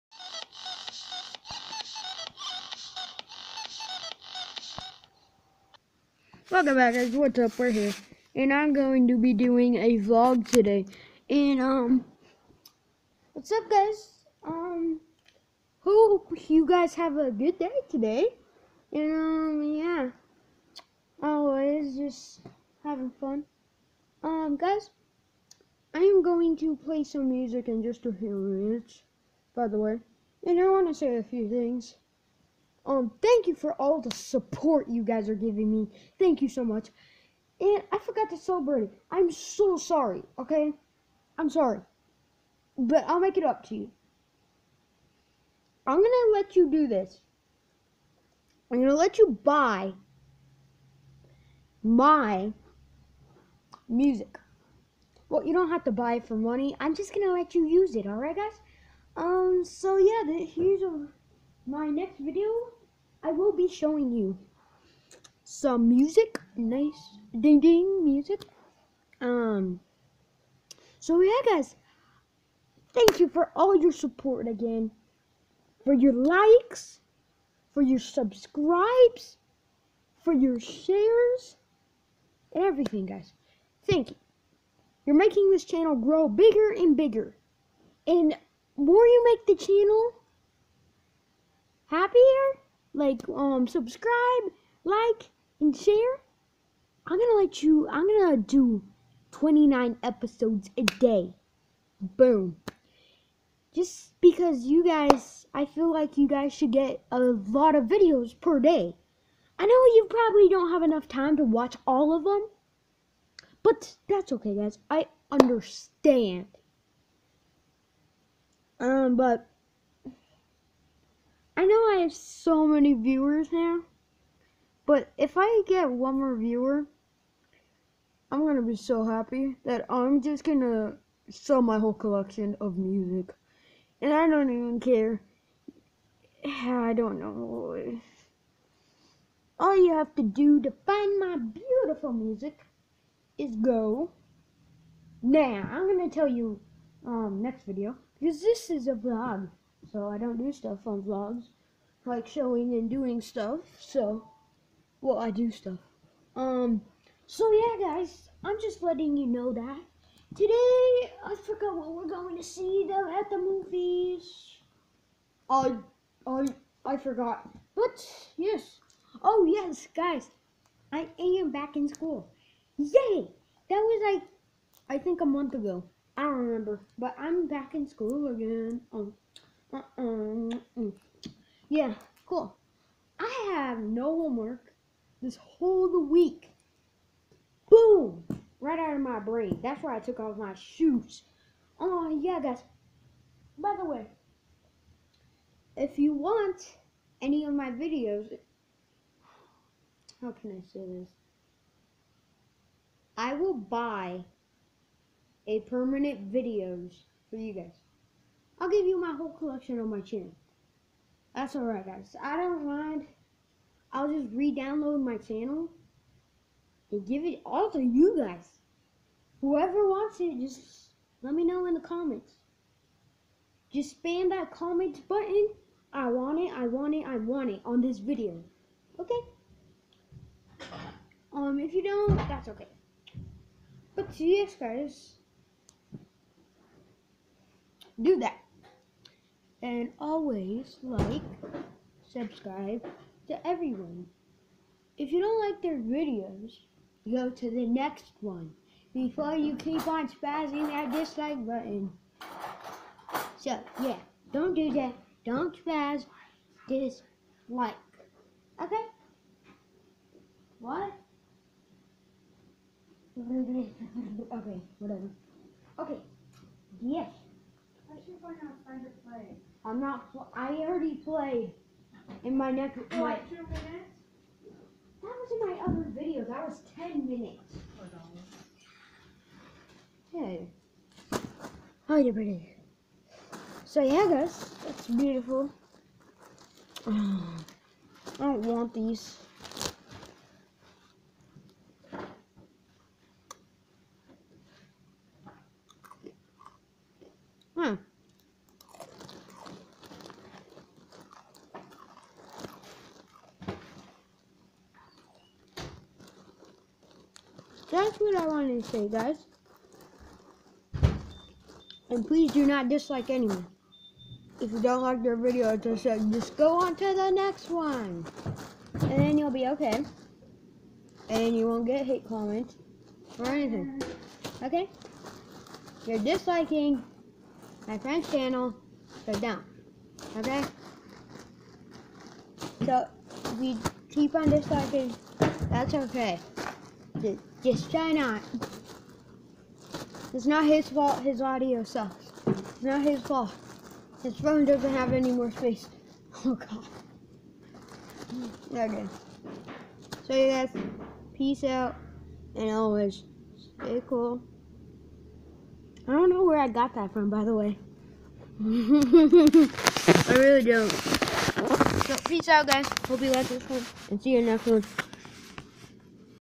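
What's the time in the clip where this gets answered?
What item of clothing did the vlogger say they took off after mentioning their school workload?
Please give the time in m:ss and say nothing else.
3:10.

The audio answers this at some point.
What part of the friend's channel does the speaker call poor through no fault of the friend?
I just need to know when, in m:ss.
5:41.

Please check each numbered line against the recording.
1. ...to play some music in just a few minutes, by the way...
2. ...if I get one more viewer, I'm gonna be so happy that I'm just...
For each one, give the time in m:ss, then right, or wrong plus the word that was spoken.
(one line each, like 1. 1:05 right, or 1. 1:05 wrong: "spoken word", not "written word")
1. 0:26 right
2. 2:05 right.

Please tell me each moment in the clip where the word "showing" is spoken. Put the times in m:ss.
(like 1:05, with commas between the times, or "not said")
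1:03, 2:32.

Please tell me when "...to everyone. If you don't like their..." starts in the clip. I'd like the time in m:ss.
4:03.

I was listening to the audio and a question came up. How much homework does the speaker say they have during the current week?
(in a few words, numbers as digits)
no homework.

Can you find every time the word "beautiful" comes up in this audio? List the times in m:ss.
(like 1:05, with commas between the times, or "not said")
2:21, 4:44.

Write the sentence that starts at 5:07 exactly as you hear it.
that's what I wanted to say, guys.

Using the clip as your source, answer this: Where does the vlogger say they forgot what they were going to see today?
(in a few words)
the movies.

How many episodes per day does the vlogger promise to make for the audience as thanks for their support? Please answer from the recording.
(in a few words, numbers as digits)
29.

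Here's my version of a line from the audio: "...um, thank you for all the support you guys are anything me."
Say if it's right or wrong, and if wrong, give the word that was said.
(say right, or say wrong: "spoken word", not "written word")
wrong: "giving", not "anything".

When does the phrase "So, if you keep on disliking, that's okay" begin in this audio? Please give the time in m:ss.
5:32.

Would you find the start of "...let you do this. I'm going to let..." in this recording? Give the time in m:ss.
0:46.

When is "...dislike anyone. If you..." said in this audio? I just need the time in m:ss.
5:12.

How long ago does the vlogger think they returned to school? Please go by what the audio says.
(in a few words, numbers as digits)
a month ago.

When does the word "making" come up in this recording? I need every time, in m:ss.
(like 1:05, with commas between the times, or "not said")
1:25.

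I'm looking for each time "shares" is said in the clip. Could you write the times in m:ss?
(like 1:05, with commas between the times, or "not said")
1:20, 1:35.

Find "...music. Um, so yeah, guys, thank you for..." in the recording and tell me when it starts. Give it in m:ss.
1:08.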